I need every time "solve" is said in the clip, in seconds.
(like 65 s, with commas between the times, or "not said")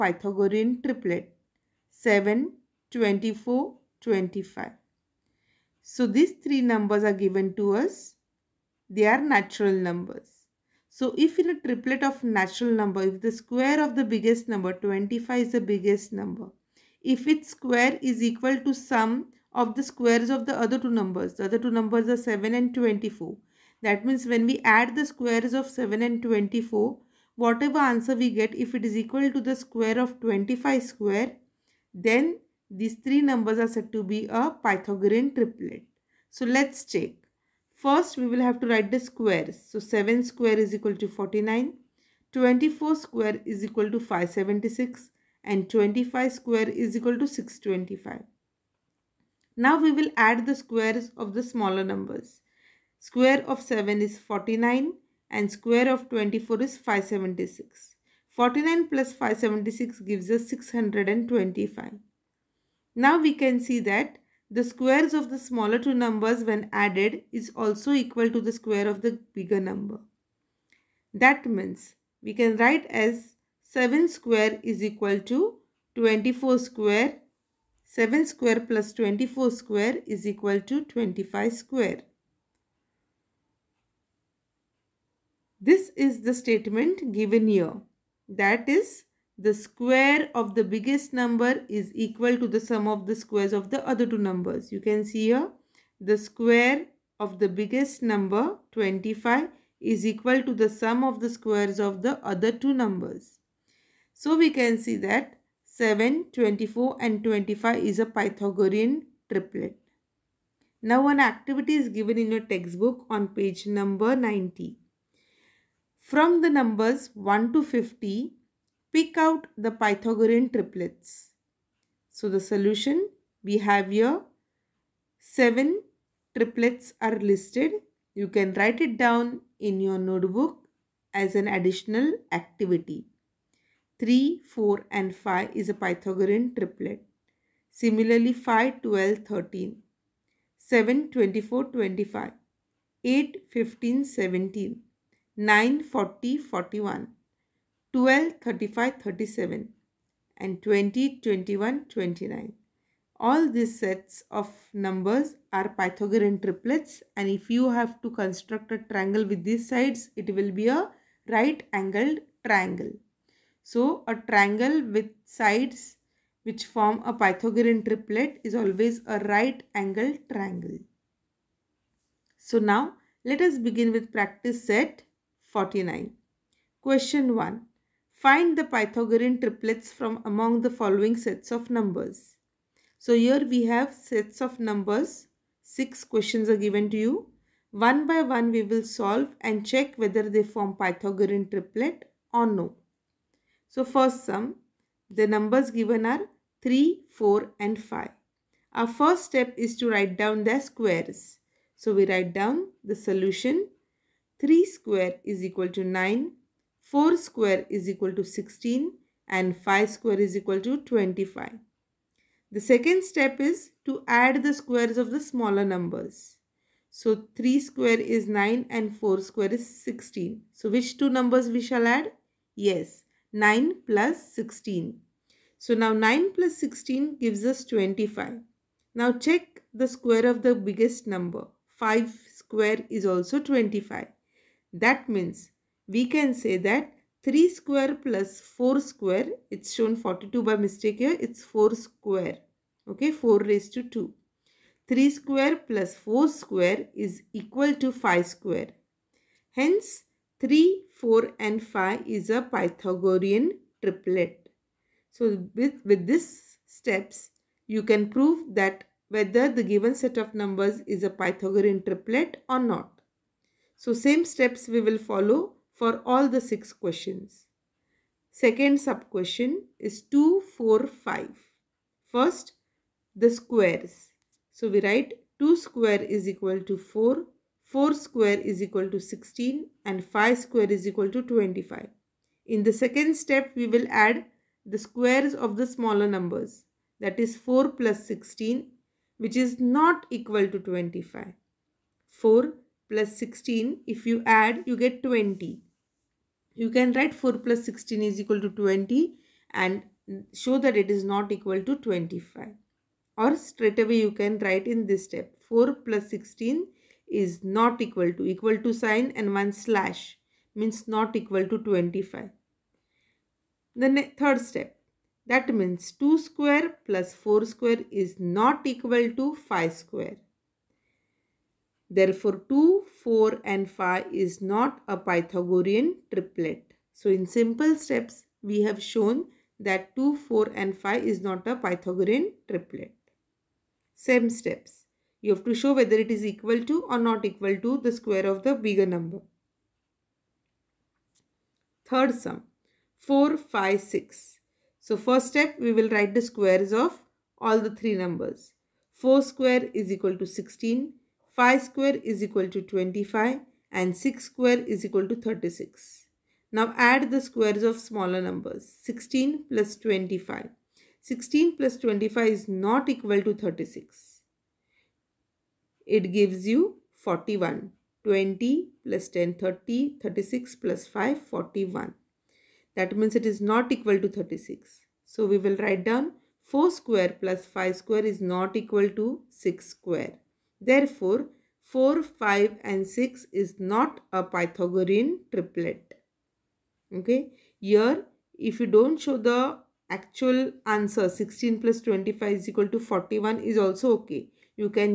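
188 s.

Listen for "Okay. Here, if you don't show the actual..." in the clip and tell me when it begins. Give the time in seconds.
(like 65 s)
386 s.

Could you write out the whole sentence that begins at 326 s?
So, in simple steps, we have shown that 2, 4 and 5 is not a Pythagorean triplet.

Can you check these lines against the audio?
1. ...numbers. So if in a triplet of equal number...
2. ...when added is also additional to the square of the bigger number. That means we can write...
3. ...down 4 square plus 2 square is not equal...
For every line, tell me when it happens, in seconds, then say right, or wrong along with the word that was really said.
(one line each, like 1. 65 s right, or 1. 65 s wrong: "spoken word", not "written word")
1. 9 s wrong: "natural", not "equal"
2. 66 s wrong: "equal", not "additional"
3. 375 s wrong: "5", not "2".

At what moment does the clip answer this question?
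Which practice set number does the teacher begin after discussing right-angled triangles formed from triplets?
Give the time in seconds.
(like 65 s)
174 s.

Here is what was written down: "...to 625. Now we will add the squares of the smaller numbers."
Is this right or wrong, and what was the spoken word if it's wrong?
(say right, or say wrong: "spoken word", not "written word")
right.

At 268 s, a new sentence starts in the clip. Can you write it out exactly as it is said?
Second sub-question is 2, 4, 5.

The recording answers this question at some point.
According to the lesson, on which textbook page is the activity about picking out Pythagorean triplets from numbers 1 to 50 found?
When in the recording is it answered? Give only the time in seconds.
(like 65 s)
113 s.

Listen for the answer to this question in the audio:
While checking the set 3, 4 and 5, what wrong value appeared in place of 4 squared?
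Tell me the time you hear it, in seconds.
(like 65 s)
239 s.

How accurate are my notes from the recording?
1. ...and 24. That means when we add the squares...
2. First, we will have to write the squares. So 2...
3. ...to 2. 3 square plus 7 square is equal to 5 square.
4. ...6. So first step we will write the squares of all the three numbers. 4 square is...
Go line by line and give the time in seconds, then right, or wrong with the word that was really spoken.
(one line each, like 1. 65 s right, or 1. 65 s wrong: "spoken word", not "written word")
1. 22 s right
2. 37 s wrong: "7", not "2"
3. 243 s wrong: "4", not "7"
4. 343 s right.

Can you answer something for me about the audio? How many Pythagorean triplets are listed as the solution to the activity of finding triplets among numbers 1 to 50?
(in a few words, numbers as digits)
7.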